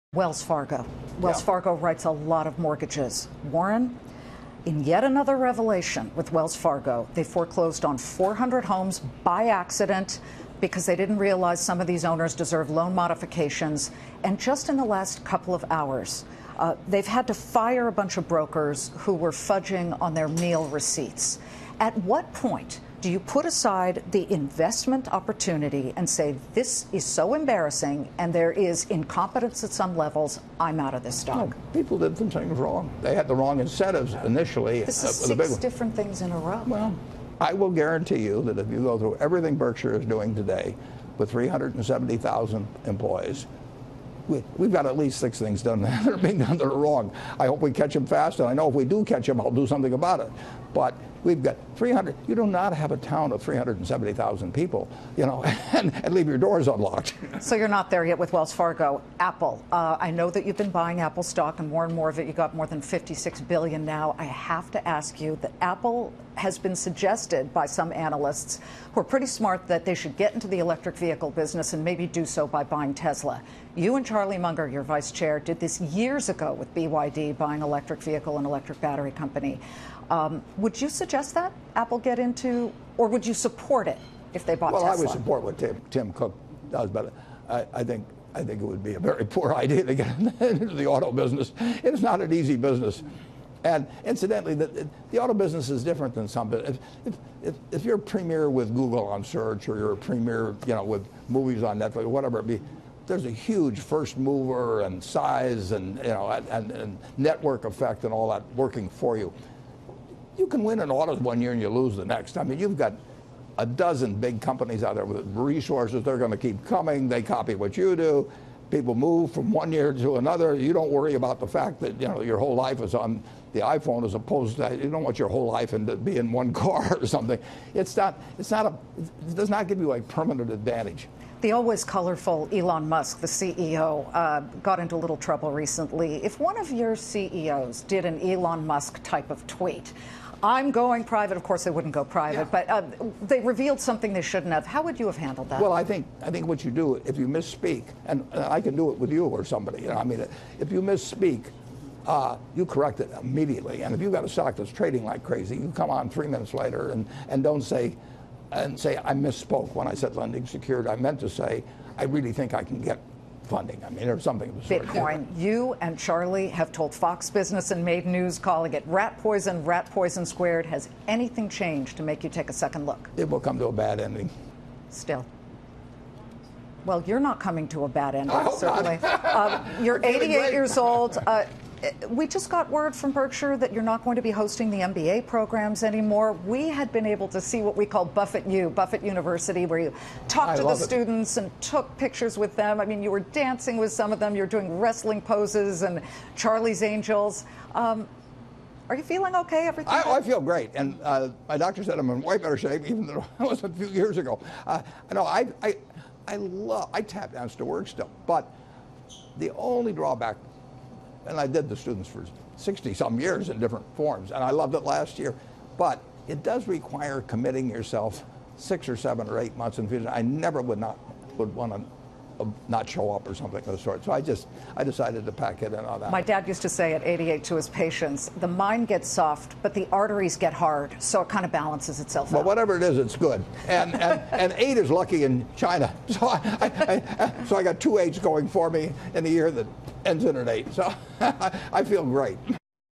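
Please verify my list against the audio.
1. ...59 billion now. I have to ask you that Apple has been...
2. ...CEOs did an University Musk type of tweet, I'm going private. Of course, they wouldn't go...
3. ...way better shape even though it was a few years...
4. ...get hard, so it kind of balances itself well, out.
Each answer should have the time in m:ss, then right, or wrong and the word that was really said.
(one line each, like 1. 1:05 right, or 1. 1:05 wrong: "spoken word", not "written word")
1. 1:02 wrong: "56", not "59"
2. 2:16 wrong: "Elon", not "University"
3. 3:22 right
4. 3:50 right.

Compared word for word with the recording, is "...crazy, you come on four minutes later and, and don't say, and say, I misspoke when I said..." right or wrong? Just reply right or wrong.
wrong.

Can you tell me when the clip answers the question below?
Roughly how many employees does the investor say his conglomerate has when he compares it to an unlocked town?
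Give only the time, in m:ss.
0:41.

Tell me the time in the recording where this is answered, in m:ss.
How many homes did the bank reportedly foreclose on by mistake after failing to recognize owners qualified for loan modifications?
0:07.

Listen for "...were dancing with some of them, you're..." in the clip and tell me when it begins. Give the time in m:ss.
3:13.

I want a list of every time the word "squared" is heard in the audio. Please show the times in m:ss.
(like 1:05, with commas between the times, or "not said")
2:50.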